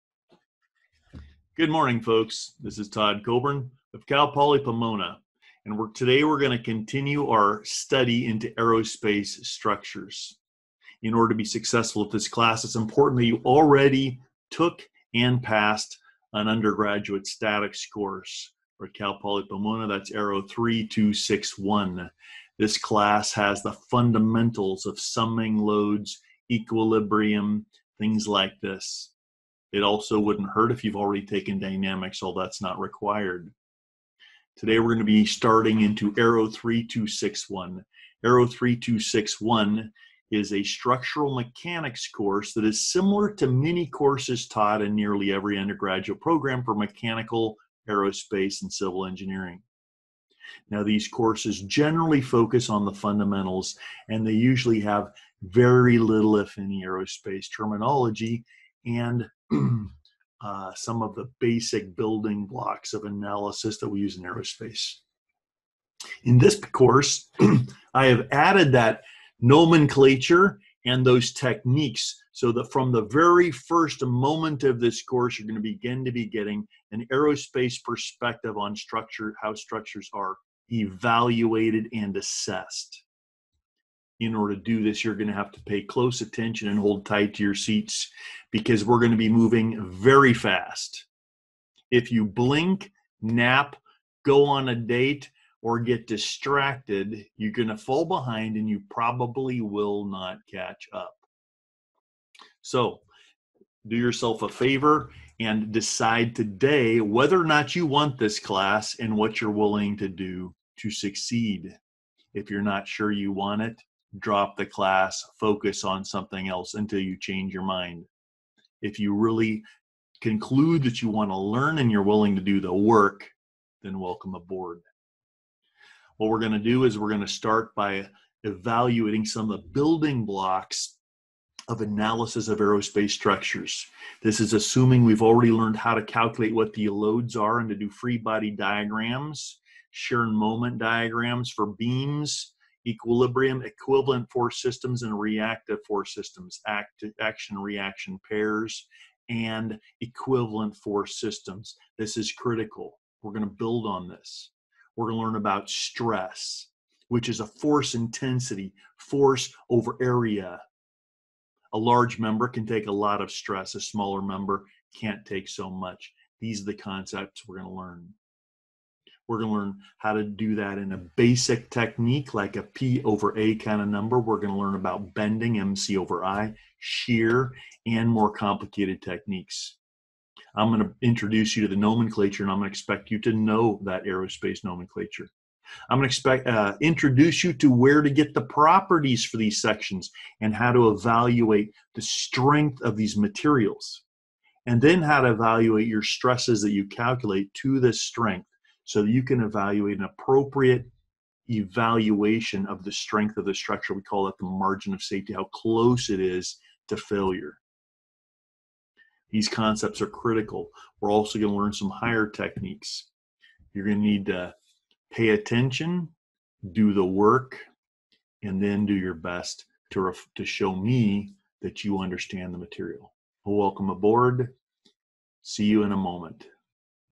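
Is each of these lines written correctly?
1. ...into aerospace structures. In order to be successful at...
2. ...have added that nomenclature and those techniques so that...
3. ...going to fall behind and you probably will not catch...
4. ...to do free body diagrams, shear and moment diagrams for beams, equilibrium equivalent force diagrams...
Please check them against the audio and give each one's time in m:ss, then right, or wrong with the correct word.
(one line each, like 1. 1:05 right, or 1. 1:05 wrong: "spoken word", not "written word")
1. 0:08 right
2. 1:08 right
3. 1:37 right
4. 2:17 wrong: "systems", not "diagrams".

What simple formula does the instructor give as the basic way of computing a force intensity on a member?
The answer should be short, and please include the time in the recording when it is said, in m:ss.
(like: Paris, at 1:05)
P over A, at 2:52.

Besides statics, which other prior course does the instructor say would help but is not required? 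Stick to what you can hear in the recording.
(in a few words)
Dynamics.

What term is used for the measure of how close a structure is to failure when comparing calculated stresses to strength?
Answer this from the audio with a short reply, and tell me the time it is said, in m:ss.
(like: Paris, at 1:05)
Margin of safety, at 3:24.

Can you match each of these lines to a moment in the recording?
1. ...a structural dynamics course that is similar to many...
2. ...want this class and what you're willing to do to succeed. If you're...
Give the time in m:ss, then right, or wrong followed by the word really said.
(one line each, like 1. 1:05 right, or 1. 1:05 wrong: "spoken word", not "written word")
1. 0:40 wrong: "mechanics", not "dynamics"
2. 1:47 right.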